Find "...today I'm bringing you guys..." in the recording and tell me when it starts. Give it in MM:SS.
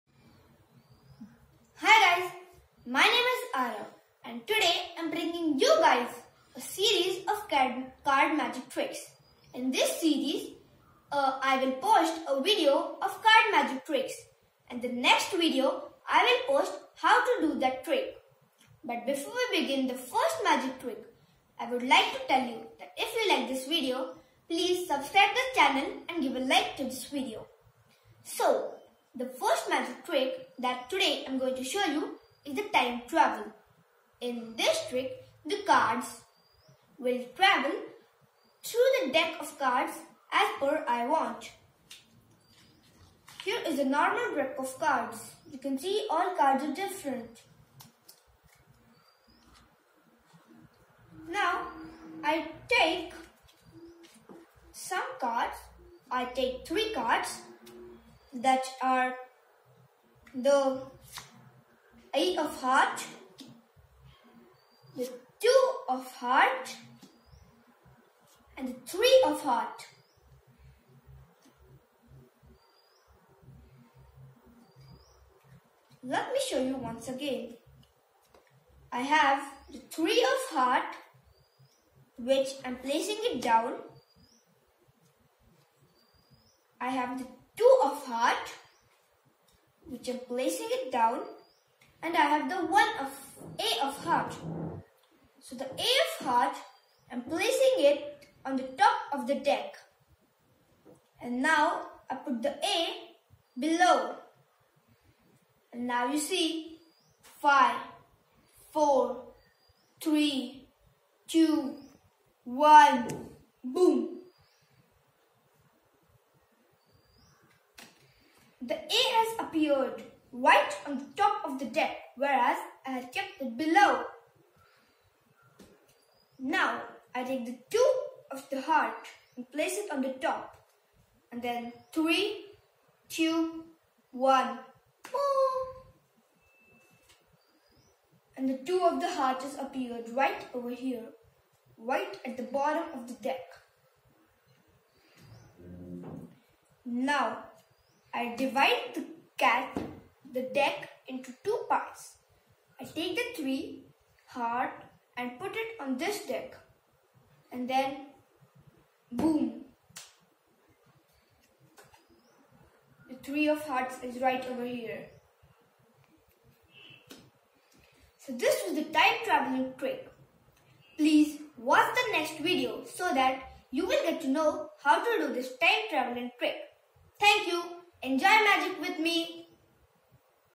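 00:04.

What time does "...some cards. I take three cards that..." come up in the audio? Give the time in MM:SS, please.
00:54.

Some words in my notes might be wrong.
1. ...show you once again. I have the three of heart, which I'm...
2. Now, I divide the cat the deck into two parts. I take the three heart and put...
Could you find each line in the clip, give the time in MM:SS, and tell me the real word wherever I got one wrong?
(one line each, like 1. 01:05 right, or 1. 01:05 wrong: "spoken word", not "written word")
1. 01:16 right
2. 02:26 right.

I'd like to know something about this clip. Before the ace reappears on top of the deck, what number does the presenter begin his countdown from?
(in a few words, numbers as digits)
5.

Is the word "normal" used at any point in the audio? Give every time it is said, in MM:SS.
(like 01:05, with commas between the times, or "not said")
00:43.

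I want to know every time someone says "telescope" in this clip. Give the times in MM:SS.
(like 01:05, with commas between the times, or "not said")
not said.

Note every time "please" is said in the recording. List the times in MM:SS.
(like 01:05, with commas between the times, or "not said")
00:24, 02:50.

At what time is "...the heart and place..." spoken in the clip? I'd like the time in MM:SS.
02:08.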